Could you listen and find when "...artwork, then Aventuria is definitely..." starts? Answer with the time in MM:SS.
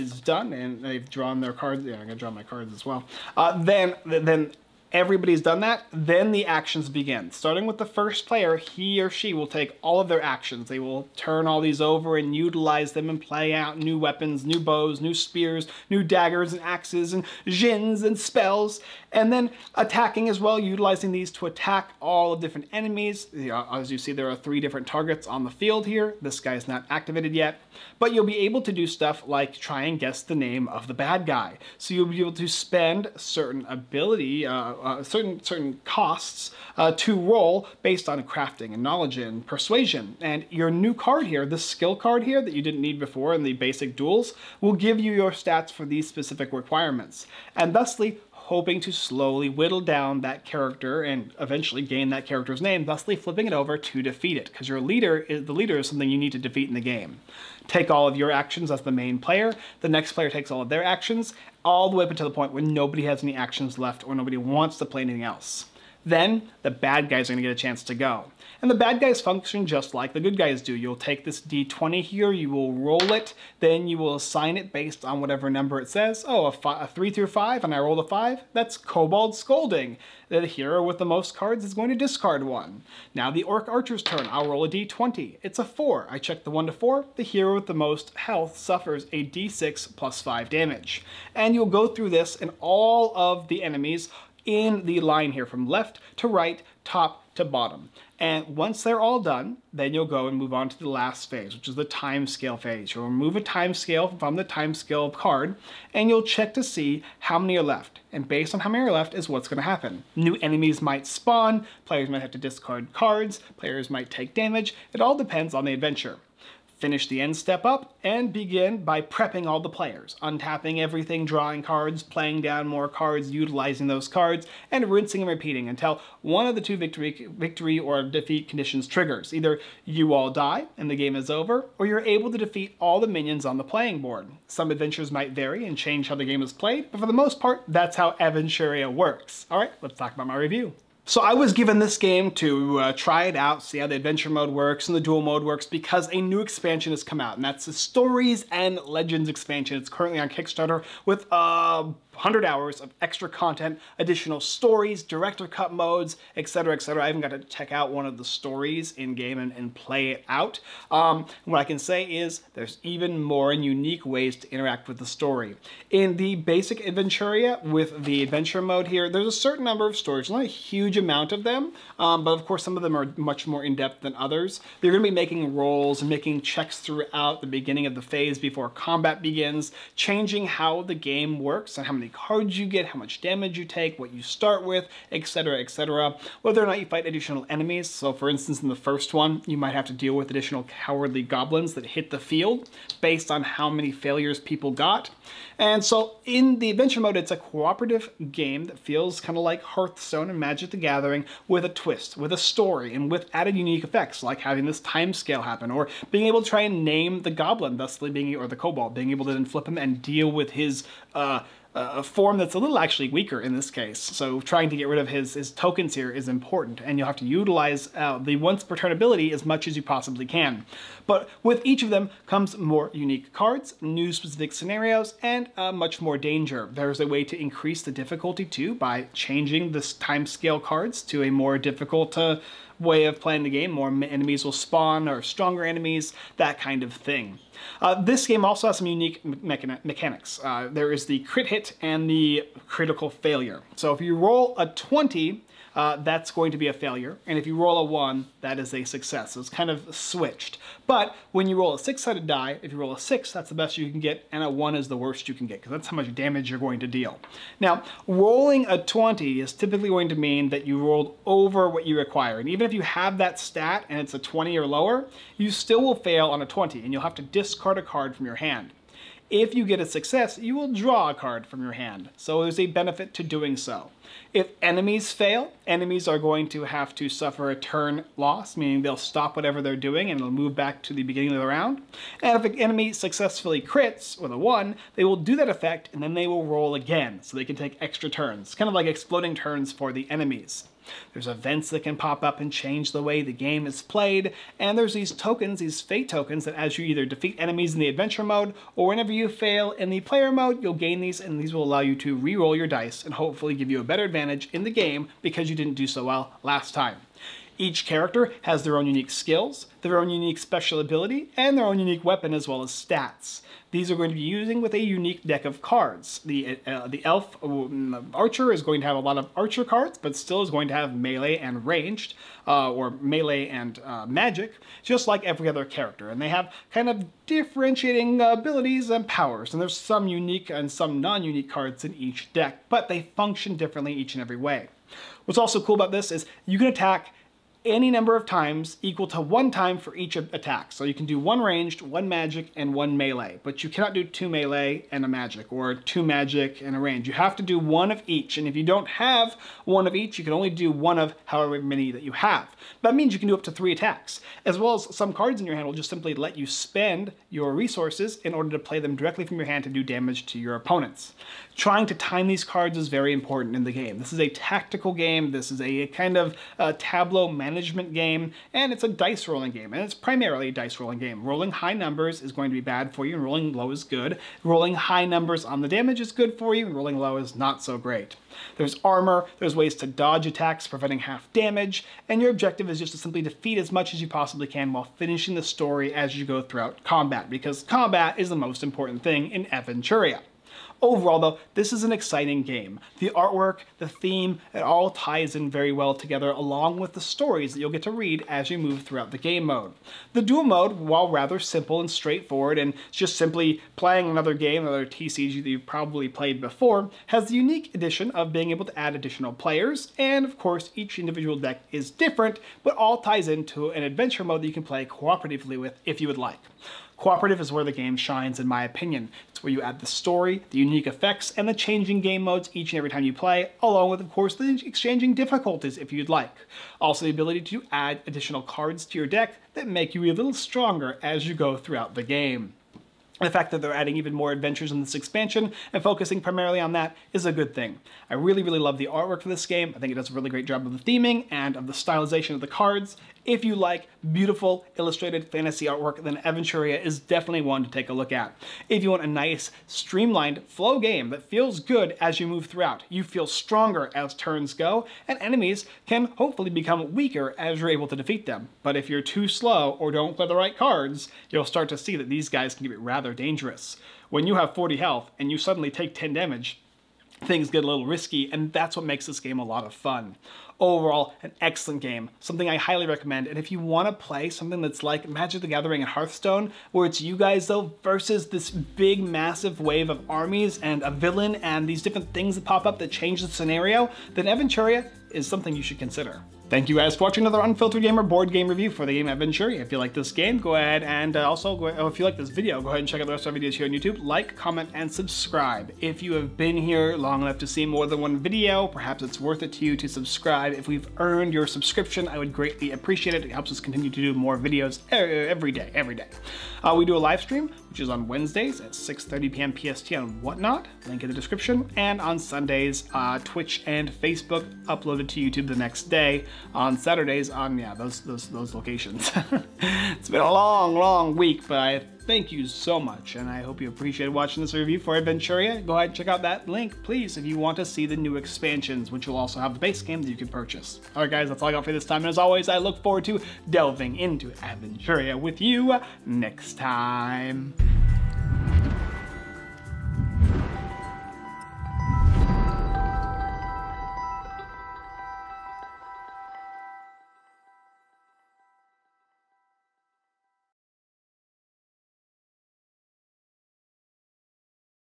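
07:25.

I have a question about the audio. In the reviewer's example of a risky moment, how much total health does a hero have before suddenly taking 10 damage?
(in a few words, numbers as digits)
40.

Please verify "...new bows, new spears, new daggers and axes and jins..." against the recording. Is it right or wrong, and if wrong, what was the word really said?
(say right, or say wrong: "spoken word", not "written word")
right.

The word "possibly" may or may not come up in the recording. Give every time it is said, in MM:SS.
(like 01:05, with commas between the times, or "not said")
03:39, 06:24.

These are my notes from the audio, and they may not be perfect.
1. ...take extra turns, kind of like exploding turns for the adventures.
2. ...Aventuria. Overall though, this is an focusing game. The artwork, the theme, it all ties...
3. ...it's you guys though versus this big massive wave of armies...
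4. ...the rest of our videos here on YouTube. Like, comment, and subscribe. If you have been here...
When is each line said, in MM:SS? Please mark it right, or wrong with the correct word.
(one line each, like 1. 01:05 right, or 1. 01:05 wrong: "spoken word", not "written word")
1. 04:47 wrong: "enemies", not "adventures"
2. 06:29 wrong: "exciting", not "focusing"
3. 07:56 right
4. 08:13 right.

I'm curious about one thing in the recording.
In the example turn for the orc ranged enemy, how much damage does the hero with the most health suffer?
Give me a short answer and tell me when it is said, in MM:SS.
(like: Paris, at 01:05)
d6 plus 5, at 01:29.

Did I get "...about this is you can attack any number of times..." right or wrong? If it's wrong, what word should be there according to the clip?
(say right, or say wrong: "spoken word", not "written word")
right.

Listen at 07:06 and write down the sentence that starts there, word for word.
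Also, the ability to add additional cards to your deck that make you a little stronger as you go throughout the game.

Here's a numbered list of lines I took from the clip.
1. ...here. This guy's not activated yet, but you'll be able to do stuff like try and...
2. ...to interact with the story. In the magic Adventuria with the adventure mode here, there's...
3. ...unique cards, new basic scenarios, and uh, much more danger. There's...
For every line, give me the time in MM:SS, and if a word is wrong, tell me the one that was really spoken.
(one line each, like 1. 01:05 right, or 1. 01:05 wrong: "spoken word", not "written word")
1. 00:25 right
2. 02:44 wrong: "basic", not "magic"
3. 03:42 wrong: "specific", not "basic".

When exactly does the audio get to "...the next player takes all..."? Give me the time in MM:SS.
00:59.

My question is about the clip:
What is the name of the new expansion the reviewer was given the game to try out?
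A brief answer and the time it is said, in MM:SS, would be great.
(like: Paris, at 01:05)
Stories and Legends, at 02:27.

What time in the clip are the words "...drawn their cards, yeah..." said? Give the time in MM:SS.
00:01.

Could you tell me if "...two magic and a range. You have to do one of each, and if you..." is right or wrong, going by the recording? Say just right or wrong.
right.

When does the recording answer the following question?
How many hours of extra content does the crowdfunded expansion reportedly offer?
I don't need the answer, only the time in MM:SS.
02:32.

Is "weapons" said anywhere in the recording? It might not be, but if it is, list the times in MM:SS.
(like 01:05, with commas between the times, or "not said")
00:13, 05:12.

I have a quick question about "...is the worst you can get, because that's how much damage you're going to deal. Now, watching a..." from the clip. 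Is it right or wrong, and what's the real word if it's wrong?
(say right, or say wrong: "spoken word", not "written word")
wrong: "rolling", not "watching".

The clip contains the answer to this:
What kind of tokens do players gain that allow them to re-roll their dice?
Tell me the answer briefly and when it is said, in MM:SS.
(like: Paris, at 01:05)
fate tokens, at 04:55.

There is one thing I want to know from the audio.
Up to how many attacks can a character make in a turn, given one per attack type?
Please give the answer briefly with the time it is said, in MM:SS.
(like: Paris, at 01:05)
3, at 05:53.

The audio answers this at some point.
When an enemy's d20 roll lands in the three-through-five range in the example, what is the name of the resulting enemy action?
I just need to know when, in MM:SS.
01:18.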